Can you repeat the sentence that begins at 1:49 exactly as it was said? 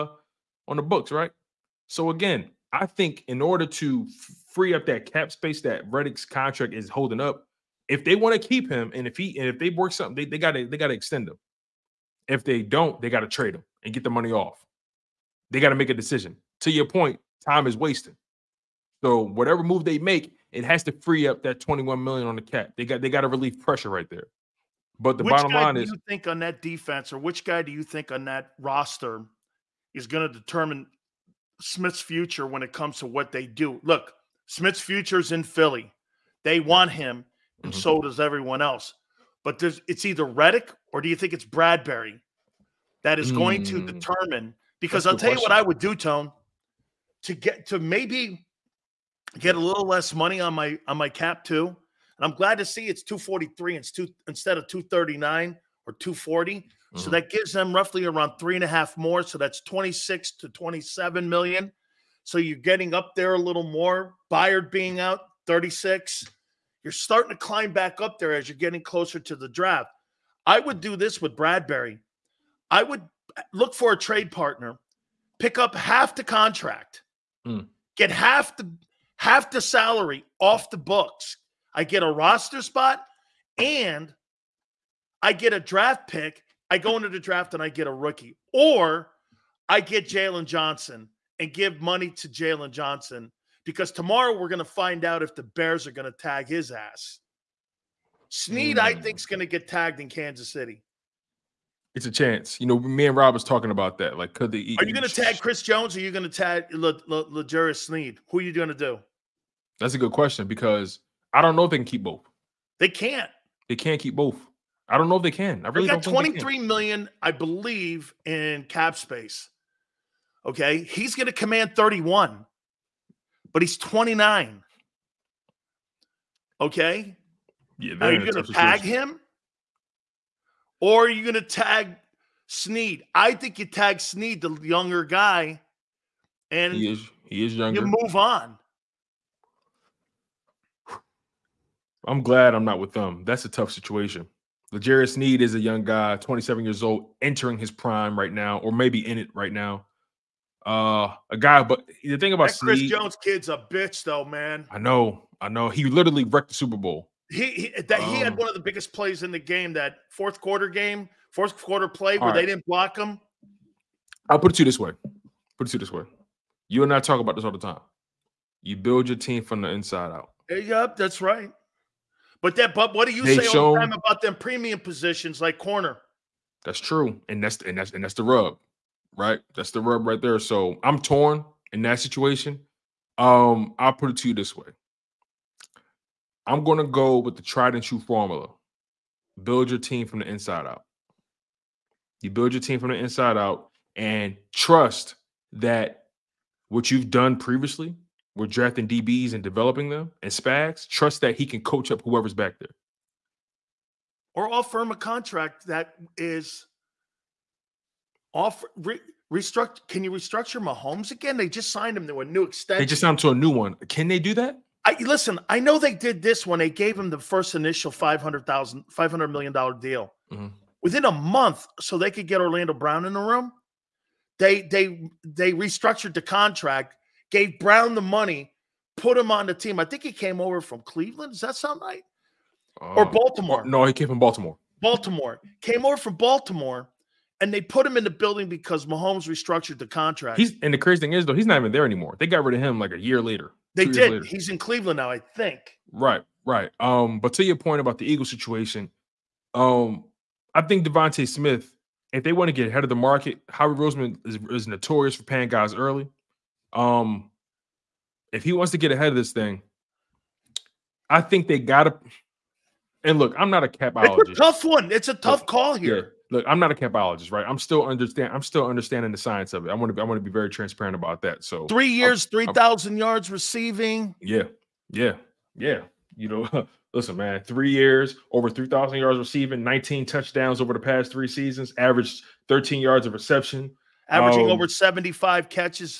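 That's a good question because – I don't know if they can keep both.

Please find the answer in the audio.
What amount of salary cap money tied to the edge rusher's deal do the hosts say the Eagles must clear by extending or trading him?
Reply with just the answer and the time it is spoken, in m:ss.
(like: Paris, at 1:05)
$21 million, at 0:21.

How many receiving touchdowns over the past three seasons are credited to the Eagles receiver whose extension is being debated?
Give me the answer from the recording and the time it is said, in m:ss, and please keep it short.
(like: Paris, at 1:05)
19, at 4:39.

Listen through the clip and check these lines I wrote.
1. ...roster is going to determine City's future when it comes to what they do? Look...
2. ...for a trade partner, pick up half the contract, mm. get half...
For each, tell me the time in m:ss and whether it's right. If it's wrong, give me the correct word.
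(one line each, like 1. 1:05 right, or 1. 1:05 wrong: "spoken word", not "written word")
1. 0:28 wrong: "Smith", not "City"
2. 1:13 right.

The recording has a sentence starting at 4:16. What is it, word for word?
Um, if he wants to get ahead of this thing, I think they gotta.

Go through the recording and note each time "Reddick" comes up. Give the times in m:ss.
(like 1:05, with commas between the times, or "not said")
0:05, 0:40.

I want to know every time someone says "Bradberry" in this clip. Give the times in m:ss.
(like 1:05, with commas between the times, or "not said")
0:41, 1:11.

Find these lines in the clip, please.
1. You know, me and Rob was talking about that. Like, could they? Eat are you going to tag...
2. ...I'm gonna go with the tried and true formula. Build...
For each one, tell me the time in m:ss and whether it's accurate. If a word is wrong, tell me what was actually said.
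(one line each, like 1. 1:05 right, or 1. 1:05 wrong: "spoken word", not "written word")
1. 1:42 right
2. 3:06 right.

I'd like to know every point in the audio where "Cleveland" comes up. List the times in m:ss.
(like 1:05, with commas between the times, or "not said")
3:50, 4:04.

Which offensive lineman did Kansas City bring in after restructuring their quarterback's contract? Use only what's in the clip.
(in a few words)
Orlando Brown.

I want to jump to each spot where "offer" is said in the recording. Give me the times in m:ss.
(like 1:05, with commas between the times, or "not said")
3:24.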